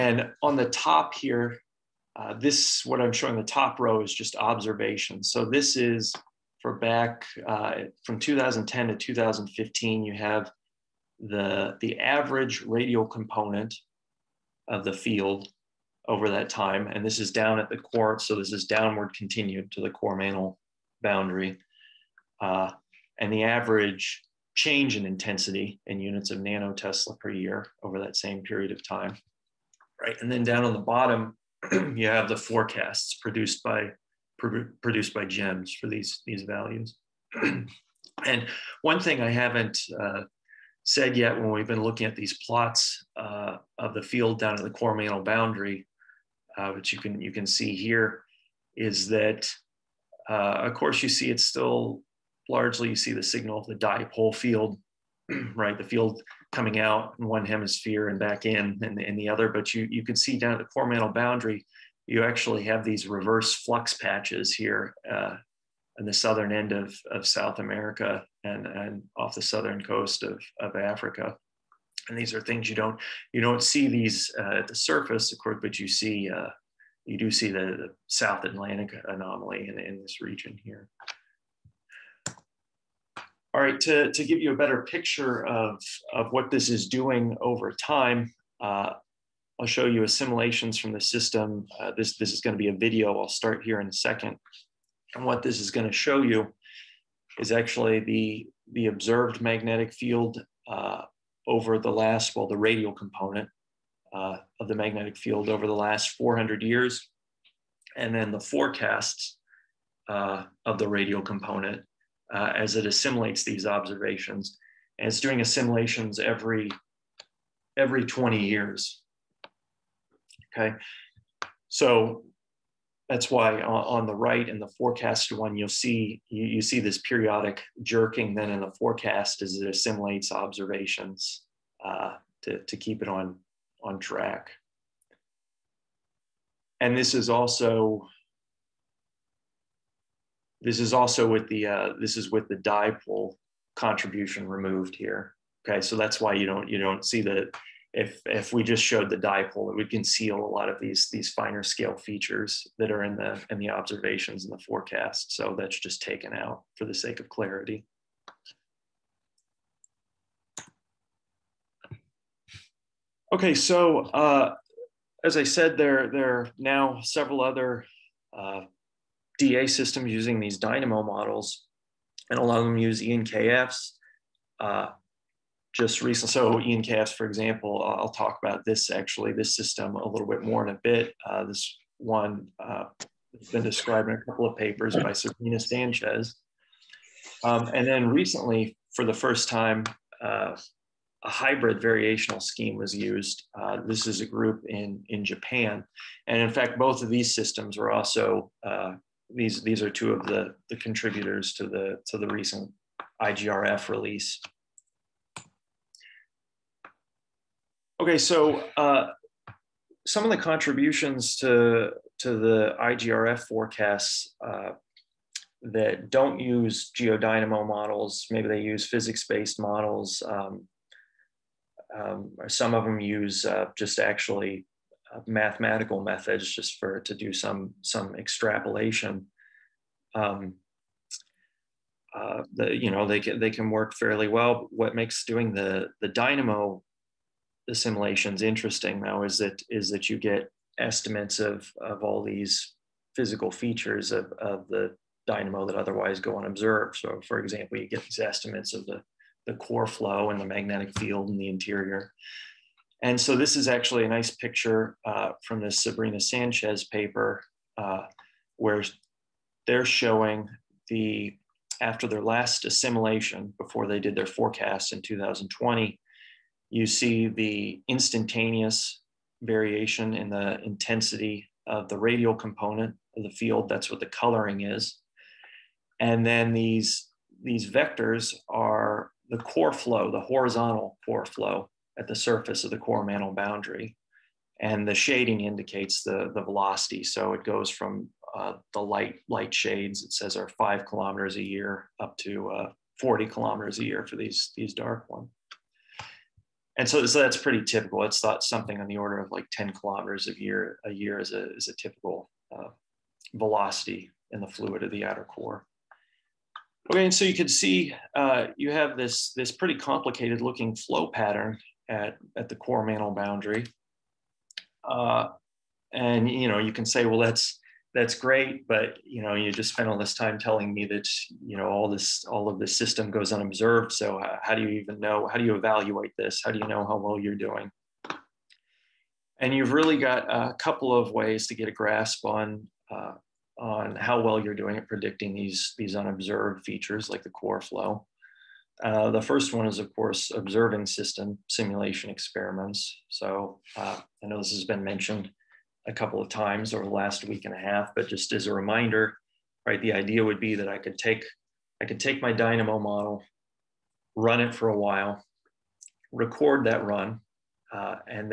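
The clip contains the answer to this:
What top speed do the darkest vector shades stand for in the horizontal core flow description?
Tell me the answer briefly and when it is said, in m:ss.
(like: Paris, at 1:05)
40 km per year, at 4:52.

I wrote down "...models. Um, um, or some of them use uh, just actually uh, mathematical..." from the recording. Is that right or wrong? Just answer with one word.
right.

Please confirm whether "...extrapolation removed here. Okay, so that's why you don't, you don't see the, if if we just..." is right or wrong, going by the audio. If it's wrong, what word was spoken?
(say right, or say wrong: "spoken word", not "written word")
wrong: "contribution", not "extrapolation".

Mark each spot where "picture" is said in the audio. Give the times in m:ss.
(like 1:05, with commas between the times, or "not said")
1:24, 4:14.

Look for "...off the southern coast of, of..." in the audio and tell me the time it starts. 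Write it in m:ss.
1:09.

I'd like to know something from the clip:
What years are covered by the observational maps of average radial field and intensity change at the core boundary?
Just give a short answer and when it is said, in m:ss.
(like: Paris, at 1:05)
2010 to 2015, at 0:08.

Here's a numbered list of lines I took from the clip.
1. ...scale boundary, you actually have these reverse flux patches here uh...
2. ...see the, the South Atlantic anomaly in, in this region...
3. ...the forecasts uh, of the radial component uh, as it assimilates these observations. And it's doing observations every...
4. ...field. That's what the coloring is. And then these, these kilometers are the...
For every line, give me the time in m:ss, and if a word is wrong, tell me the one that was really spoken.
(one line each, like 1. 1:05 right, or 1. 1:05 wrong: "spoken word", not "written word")
1. 1:00 wrong: "mantle", not "scale"
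2. 1:17 right
3. 1:48 wrong: "assimilations", not "observations"
4. 4:33 wrong: "vectors", not "kilometers".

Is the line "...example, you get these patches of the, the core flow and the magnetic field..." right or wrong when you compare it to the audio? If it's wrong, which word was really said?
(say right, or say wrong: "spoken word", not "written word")
wrong: "estimates", not "patches".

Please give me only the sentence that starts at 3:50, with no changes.
Um, uh, the, you know they can, they can work fairly well.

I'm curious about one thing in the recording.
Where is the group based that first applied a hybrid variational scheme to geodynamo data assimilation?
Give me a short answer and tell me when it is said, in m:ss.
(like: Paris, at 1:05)
Japan, at 3:15.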